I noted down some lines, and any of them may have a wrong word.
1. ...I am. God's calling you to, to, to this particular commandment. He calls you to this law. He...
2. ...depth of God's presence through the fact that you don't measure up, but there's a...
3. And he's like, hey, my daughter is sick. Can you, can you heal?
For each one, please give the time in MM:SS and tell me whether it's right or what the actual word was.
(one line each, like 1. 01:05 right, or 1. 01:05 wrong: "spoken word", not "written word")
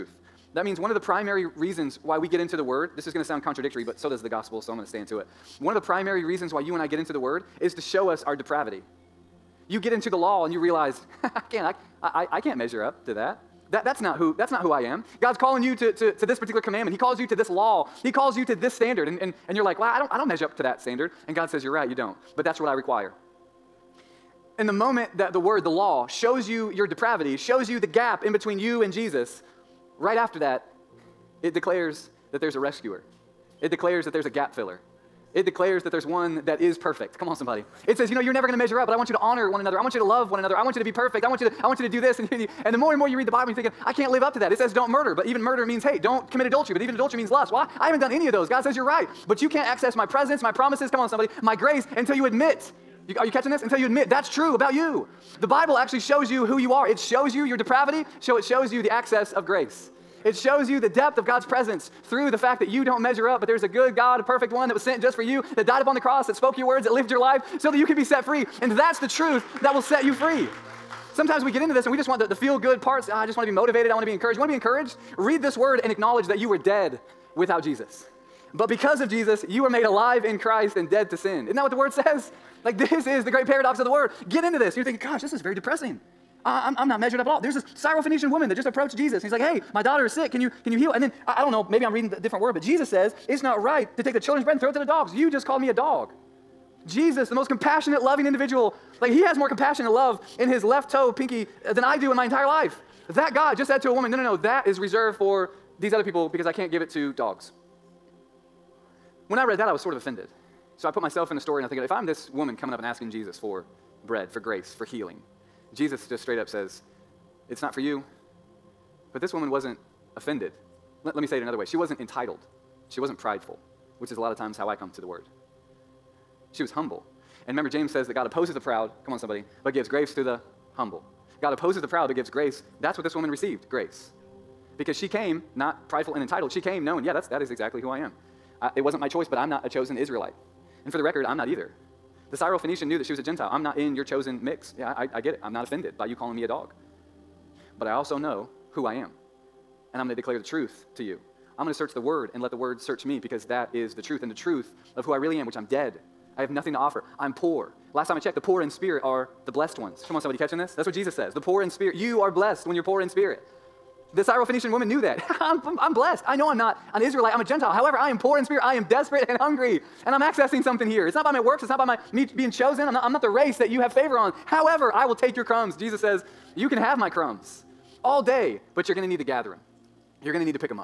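1. 00:14 right
2. 01:00 right
3. 01:29 right.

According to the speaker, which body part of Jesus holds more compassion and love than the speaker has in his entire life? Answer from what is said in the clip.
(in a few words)
left toe pinky.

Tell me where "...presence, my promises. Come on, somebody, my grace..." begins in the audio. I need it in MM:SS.
00:50.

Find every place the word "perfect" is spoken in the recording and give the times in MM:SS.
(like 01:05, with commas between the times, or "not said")
00:36, 00:40, 01:04.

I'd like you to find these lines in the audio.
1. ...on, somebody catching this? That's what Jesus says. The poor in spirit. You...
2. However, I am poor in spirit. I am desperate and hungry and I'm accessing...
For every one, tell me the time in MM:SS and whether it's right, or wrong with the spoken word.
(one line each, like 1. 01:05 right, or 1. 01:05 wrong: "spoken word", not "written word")
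1. 02:40 right
2. 02:47 right.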